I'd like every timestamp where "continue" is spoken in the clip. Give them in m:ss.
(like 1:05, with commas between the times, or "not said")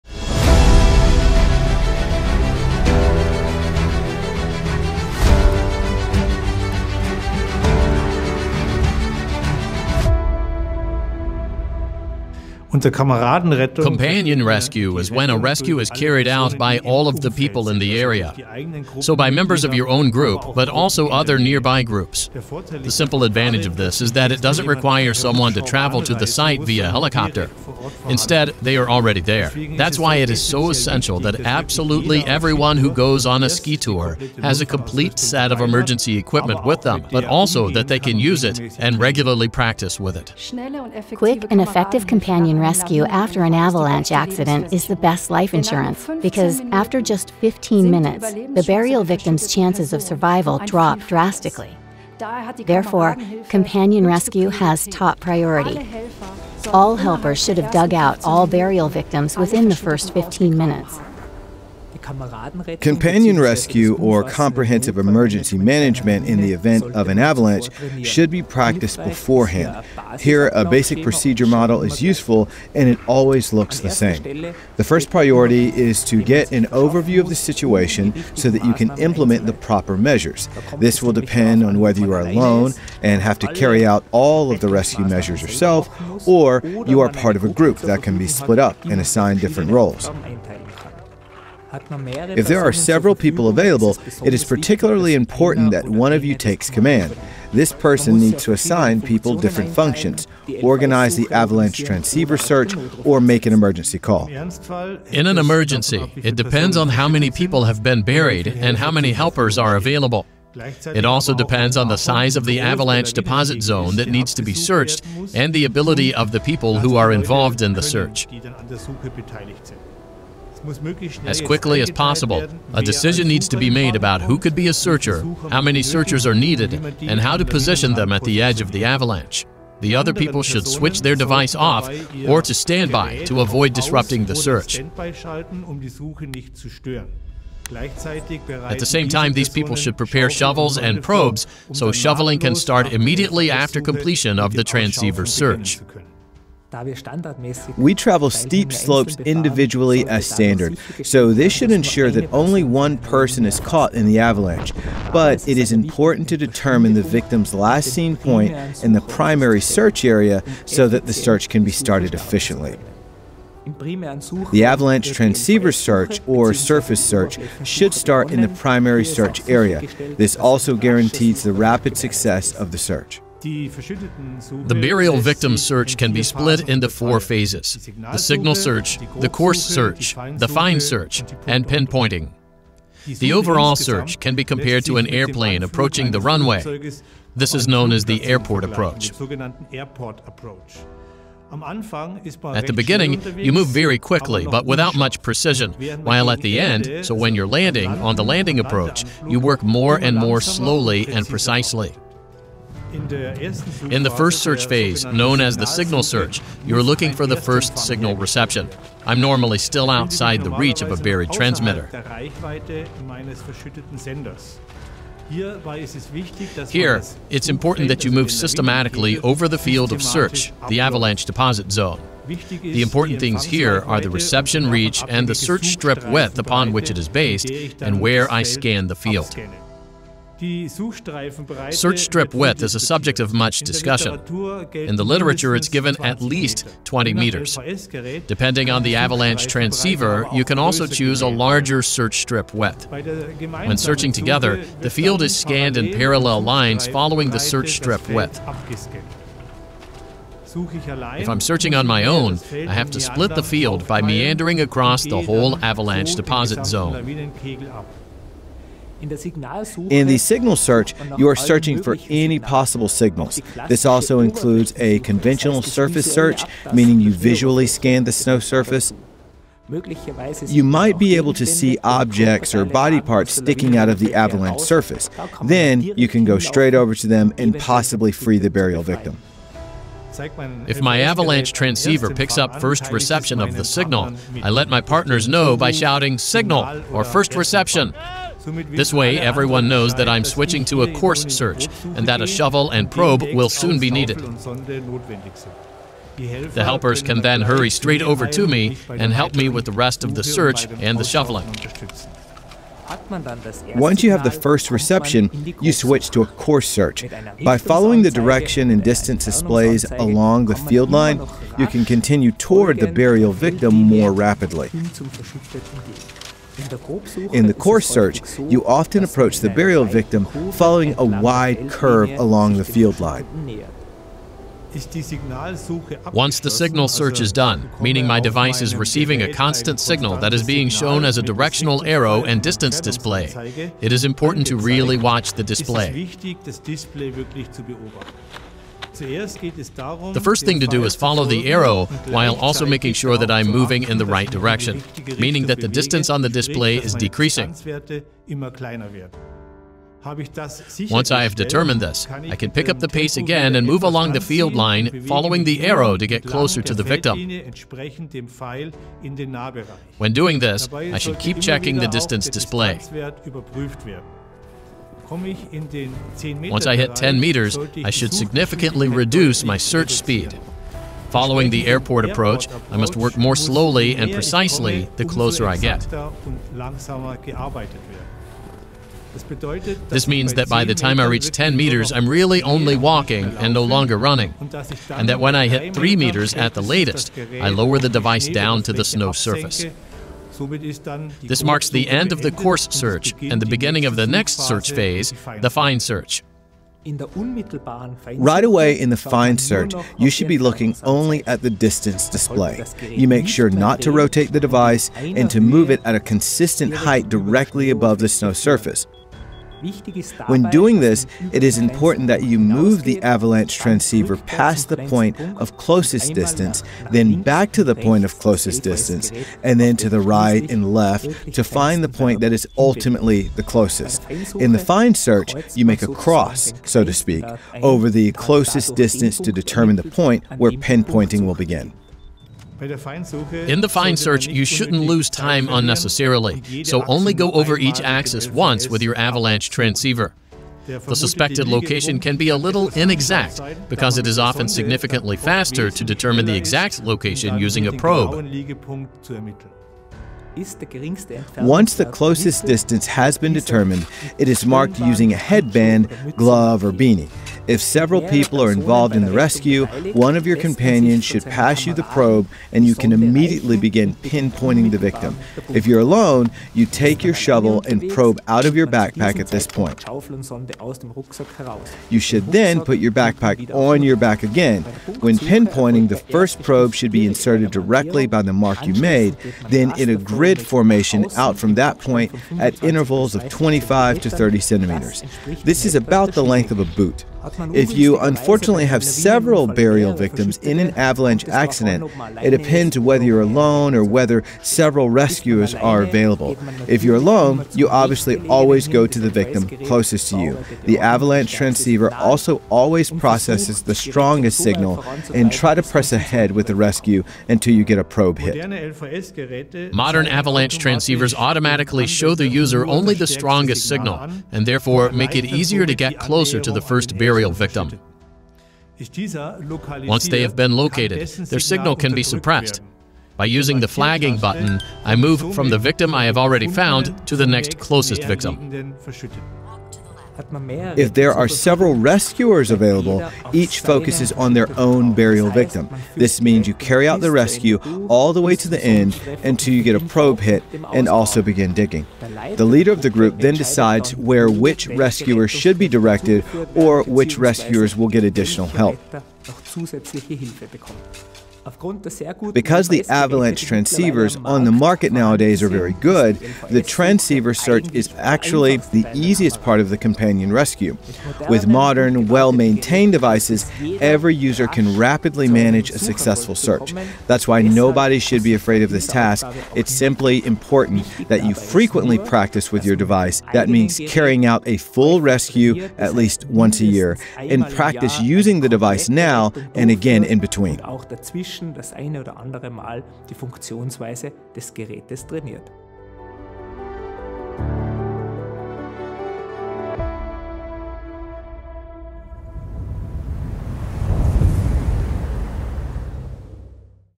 5:11.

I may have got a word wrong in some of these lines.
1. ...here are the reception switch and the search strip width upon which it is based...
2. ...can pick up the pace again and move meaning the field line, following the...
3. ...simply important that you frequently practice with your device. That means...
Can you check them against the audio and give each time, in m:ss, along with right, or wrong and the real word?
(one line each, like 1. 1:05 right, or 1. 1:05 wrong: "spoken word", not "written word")
1. 3:43 wrong: "reach", not "switch"
2. 5:52 wrong: "along", not "meaning"
3. 9:29 right.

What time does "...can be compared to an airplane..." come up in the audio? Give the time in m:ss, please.
3:04.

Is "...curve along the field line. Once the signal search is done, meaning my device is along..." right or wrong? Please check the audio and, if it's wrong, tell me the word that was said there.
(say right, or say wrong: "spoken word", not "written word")
wrong: "receiving", not "along".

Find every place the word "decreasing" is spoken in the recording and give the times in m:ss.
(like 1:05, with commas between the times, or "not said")
5:46.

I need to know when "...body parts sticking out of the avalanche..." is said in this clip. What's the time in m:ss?
4:32.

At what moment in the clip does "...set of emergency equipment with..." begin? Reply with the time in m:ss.
0:35.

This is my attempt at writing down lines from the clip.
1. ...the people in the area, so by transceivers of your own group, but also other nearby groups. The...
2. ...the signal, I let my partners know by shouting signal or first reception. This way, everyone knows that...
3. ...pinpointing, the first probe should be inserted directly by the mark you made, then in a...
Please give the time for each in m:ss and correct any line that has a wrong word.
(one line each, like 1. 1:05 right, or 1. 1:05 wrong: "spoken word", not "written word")
1. 0:17 wrong: "members", not "transceivers"
2. 4:43 right
3. 7:55 right.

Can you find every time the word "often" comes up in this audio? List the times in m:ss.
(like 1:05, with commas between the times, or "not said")
5:18, 7:24.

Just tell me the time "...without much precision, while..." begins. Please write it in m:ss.
3:14.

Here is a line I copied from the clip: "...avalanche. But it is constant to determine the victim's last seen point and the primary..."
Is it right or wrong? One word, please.
wrong.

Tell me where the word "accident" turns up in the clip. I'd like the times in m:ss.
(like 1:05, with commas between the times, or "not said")
0:44, 8:11.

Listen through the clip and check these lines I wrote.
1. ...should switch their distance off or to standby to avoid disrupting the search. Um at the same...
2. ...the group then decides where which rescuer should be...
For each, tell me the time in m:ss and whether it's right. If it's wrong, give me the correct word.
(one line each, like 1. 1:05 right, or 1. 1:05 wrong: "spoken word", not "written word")
1. 2:10 wrong: "device", not "distance"
2. 9:02 right.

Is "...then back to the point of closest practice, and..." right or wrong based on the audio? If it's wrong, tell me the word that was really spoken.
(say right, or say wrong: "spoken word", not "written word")
wrong: "distance", not "practice".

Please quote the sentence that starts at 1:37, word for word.
This person needs to assign people different functions, organize the avalanche transceiver search, or make an emergency call.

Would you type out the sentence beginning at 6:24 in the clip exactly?
And that when I hit 3 meters at the latest, I lower the device down to the snow surface.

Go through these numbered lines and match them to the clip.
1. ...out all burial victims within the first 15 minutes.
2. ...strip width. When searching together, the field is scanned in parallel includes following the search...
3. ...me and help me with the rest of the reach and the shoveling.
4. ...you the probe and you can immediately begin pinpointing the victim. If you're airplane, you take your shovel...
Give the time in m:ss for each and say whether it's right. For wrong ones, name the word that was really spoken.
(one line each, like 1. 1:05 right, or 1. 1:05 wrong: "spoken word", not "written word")
1. 0:57 right
2. 4:02 wrong: "lines", not "includes"
3. 4:58 wrong: "search", not "reach"
4. 7:41 wrong: "alone", not "airplane".